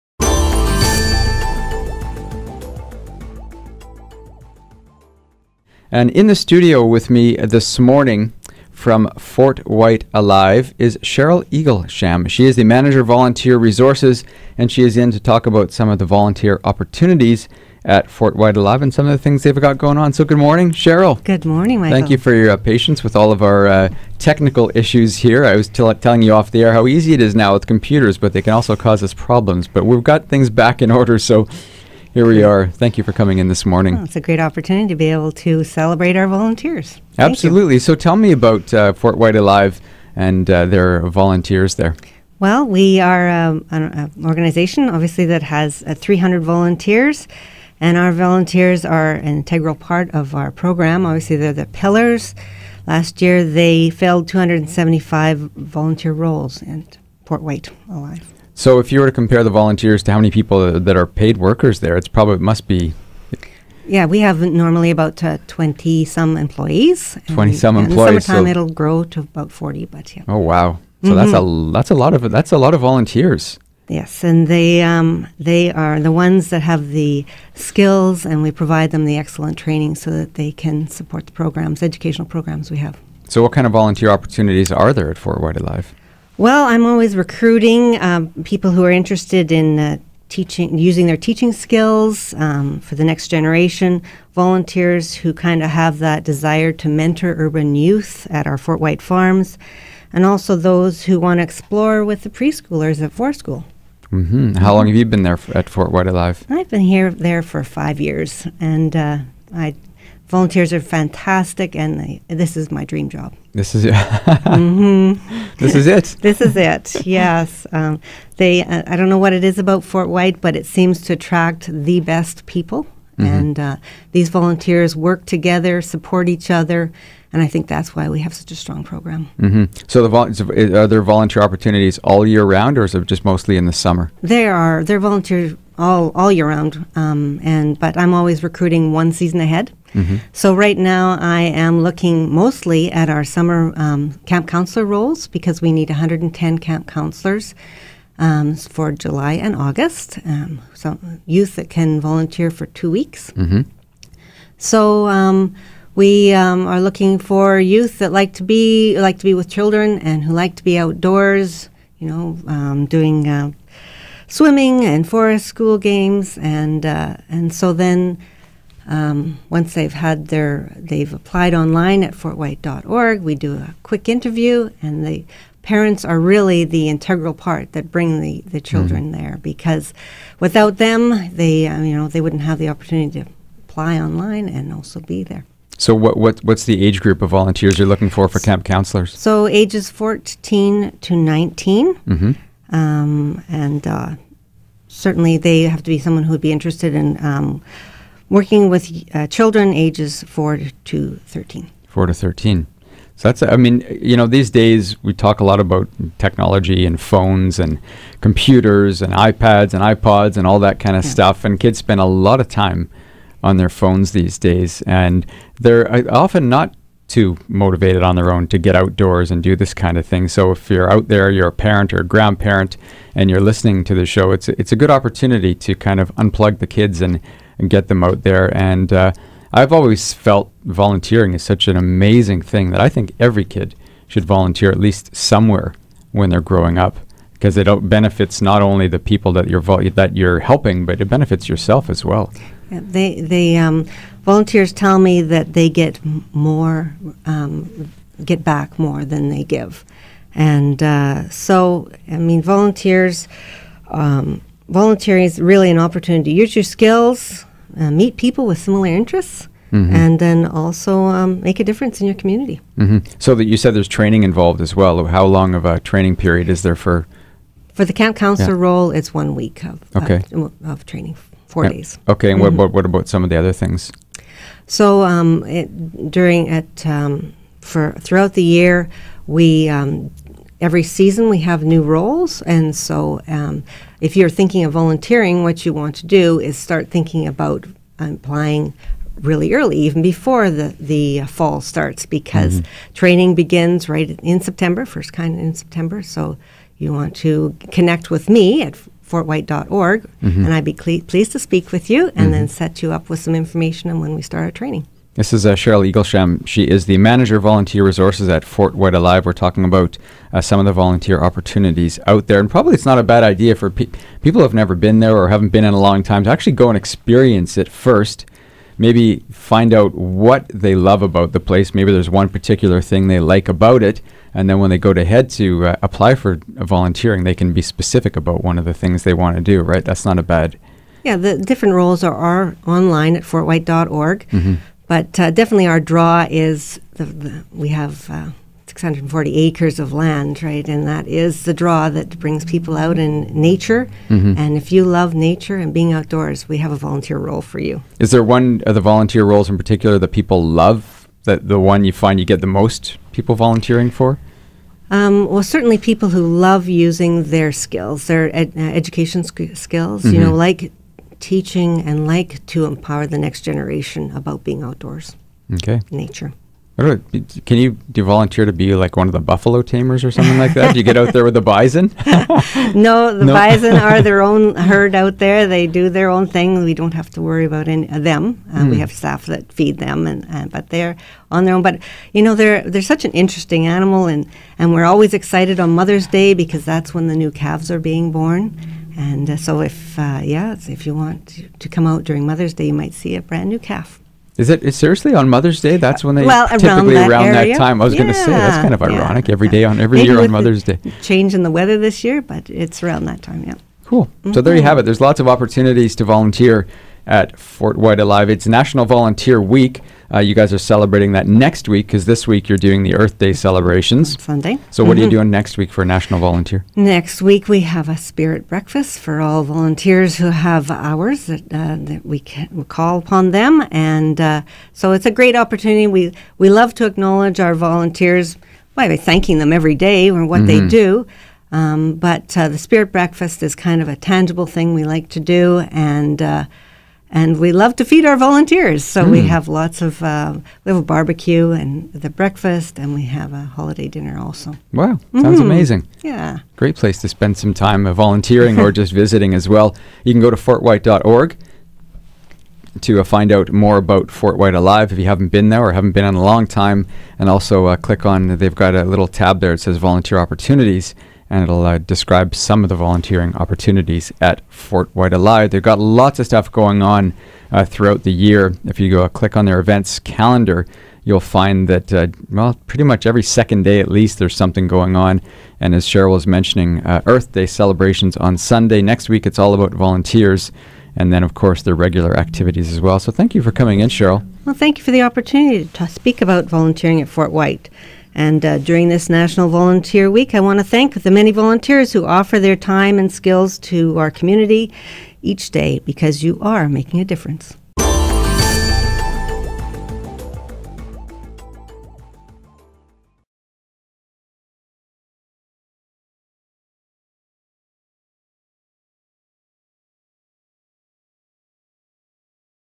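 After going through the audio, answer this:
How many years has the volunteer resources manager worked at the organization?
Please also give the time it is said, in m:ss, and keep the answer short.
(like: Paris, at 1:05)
5 years, at 1:47.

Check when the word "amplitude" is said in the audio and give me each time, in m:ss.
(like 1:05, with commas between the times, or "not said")
not said.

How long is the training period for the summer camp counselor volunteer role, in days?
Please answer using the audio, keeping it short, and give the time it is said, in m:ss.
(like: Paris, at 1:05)
4 days, at 4:31.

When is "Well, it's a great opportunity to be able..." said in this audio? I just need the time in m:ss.
0:33.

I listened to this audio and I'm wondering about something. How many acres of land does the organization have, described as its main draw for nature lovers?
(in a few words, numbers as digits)
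640 acres.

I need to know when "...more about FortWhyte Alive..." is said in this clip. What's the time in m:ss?
7:33.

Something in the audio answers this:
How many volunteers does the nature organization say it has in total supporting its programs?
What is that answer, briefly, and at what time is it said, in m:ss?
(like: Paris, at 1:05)
300, at 0:45.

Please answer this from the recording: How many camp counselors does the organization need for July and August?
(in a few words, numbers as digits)
110.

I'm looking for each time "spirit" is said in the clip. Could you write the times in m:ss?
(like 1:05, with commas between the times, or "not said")
6:57, 7:12.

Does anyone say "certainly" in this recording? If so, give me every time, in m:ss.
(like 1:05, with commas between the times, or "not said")
3:14, 5:55.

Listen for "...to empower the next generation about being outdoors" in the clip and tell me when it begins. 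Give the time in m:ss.
6:02.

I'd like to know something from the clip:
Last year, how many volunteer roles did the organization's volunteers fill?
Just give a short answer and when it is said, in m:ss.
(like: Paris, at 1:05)
275, at 0:54.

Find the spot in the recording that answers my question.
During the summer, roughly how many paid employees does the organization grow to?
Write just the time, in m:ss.
1:09.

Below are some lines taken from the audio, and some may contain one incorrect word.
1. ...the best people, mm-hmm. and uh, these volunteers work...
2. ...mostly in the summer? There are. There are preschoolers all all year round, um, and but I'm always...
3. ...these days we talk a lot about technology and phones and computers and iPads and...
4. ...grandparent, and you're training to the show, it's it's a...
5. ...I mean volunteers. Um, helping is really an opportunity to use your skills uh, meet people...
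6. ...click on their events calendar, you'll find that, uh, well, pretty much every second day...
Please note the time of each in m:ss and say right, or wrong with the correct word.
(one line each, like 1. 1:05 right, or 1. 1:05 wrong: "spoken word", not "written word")
1. 2:01 right
2. 2:13 wrong: "volunteers", not "preschoolers"
3. 3:24 right
4. 3:42 wrong: "listening", not "training"
5. 4:12 wrong: "volunteering", not "helping"
6. 7:49 right.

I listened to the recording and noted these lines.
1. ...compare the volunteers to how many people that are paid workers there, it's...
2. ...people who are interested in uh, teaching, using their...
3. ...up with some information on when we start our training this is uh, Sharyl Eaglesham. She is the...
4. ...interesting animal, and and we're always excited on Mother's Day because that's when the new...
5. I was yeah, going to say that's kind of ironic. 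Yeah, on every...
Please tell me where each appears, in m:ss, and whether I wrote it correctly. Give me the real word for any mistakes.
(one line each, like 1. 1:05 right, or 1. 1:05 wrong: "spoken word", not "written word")
1. 0:59 right
2. 1:28 right
3. 5:02 right
4. 6:23 right
5. 6:37 right.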